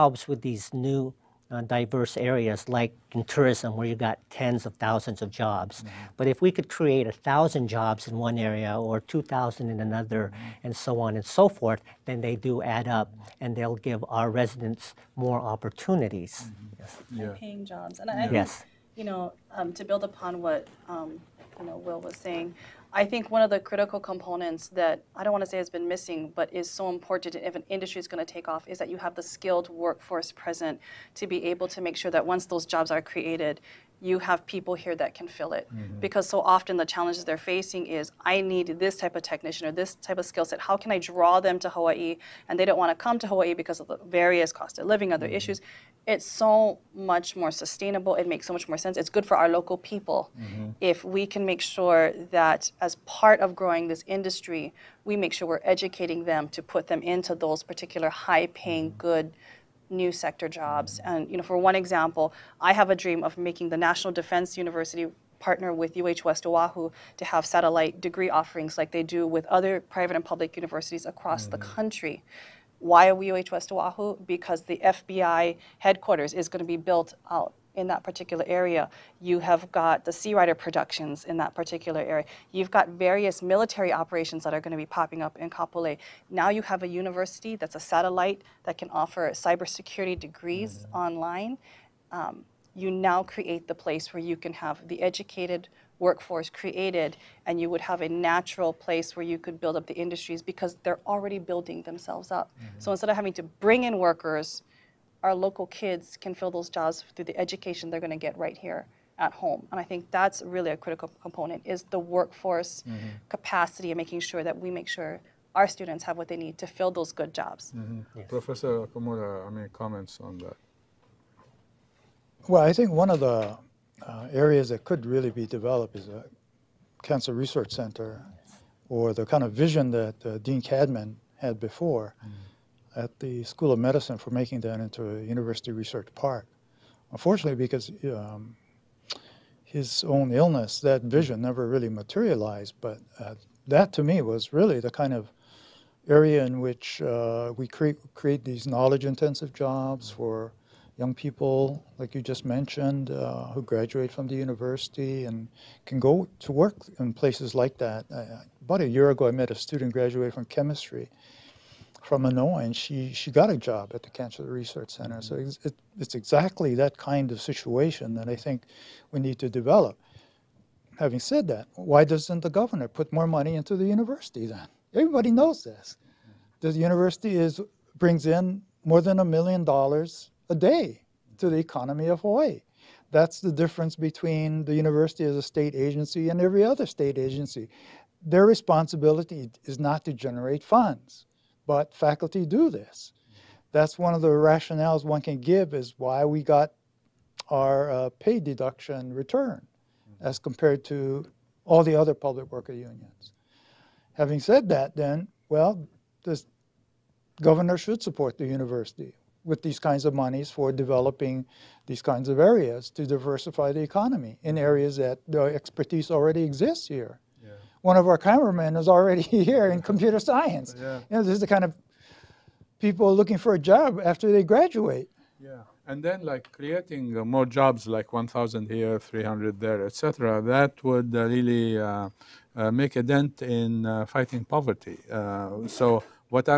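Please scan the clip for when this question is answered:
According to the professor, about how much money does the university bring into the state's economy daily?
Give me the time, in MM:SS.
02:58.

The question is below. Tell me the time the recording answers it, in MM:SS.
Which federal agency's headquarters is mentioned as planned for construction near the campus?
01:14.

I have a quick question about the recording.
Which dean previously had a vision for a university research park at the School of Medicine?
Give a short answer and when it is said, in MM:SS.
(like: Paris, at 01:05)
Dean Cadman, at 02:10.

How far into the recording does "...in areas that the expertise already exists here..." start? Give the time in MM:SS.
03:34.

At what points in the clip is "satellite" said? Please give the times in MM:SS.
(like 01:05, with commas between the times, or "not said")
01:07, 01:27.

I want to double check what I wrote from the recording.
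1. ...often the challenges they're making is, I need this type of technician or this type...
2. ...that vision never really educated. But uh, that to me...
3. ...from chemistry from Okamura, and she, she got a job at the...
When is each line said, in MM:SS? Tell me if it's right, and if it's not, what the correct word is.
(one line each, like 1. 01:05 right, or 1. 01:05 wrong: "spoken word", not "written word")
1. 00:36 wrong: "facing", not "making"
2. 02:20 wrong: "materialized", not "educated"
3. 02:40 wrong: "Illinois", not "Okamura".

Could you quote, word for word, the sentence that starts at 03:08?
Their responsibility is not to generate funds but faculty do this.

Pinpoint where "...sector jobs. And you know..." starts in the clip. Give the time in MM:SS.
01:00.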